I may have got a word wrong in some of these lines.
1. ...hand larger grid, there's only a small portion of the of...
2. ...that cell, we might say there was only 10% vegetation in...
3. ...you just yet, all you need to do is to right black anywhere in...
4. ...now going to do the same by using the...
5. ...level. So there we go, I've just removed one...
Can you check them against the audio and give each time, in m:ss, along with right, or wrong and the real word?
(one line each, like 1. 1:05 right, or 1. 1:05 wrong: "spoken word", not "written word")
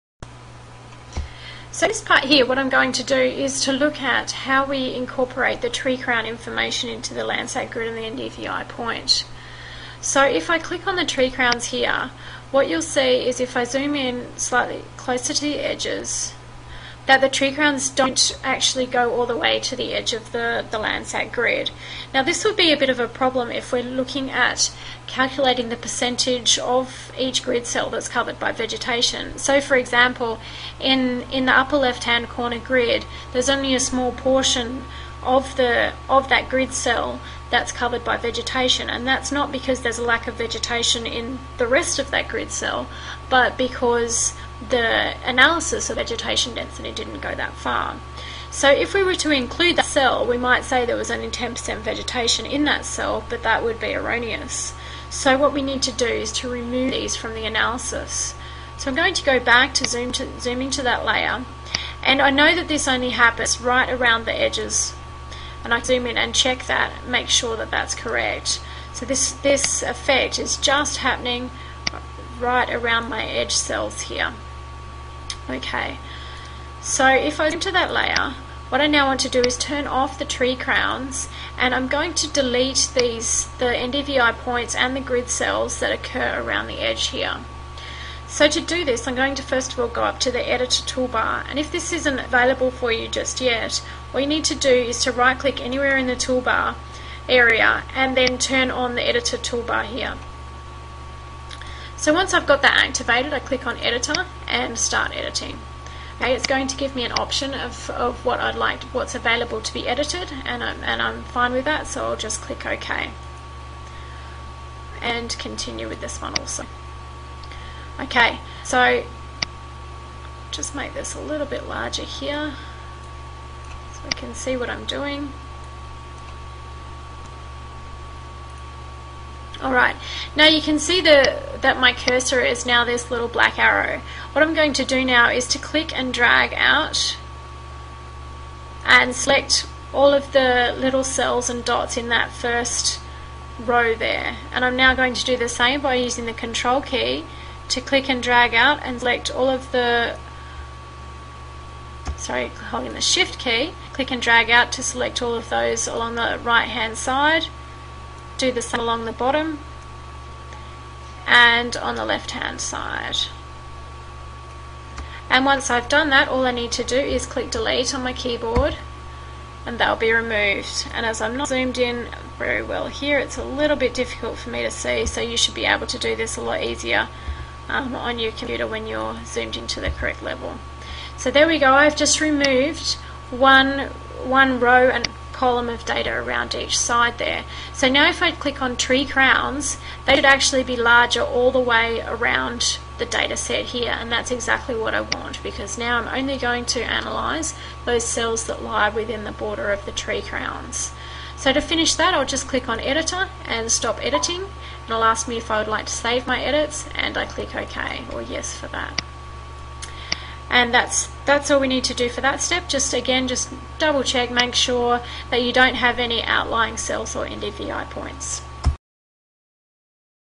1. 0:32 wrong: "corner", not "larger"
2. 0:49 right
3. 1:32 wrong: "click", not "black"
4. 2:24 right
5. 3:00 right.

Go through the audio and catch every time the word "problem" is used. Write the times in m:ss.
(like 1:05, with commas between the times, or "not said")
0:23.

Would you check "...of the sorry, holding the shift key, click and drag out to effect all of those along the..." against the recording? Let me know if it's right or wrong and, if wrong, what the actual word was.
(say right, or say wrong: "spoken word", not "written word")
wrong: "select", not "effect".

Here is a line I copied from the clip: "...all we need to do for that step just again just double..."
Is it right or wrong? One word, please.
right.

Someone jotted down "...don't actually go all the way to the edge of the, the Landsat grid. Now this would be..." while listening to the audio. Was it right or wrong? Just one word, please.
right.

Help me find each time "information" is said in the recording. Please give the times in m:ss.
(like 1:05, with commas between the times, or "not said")
0:06.